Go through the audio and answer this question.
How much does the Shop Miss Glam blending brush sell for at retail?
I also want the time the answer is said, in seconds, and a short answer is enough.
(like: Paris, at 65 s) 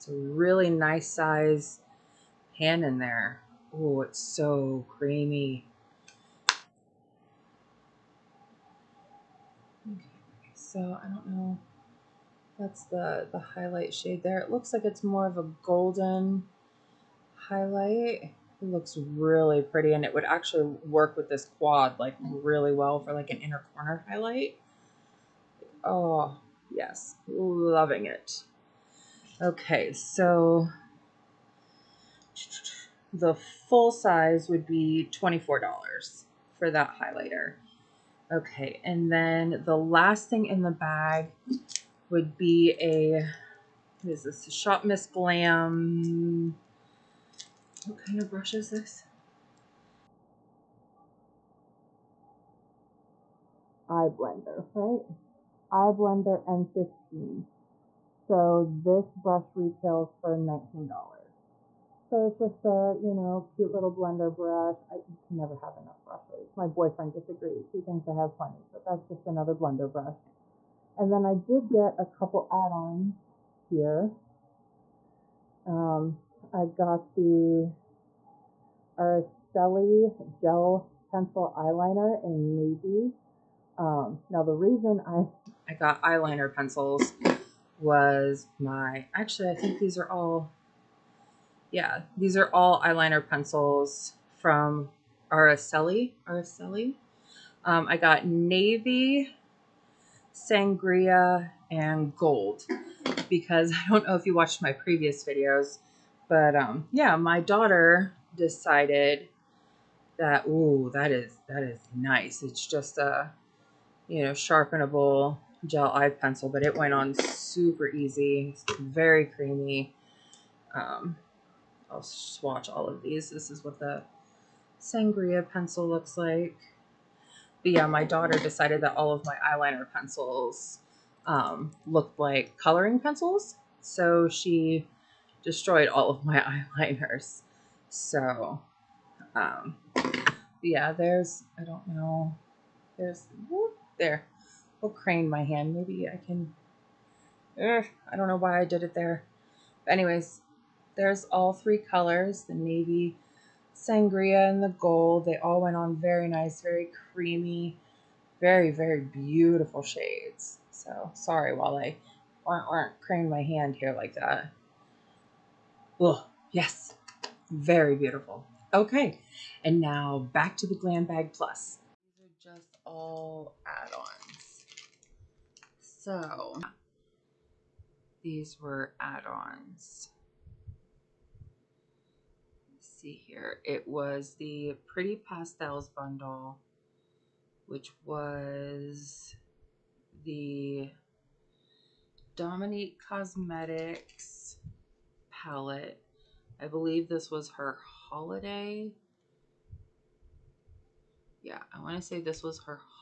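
$19, at 60 s.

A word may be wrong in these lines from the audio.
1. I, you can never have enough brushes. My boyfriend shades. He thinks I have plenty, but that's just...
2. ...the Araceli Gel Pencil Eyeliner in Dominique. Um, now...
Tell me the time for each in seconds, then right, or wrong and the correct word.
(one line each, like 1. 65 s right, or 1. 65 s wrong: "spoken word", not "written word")
1. 64 s wrong: "disagrees", not "shades"
2. 77 s wrong: "Navy", not "Dominique".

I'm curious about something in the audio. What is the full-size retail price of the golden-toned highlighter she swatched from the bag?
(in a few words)
$24.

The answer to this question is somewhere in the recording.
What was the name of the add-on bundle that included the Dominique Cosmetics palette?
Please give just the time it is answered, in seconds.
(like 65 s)
184 s.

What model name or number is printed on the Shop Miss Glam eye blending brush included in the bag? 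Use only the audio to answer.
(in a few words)
M15.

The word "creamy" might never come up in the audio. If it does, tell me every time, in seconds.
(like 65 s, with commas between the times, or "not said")
4 s, 119 s, 157 s.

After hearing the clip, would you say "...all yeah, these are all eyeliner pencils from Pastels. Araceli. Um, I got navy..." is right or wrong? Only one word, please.
wrong.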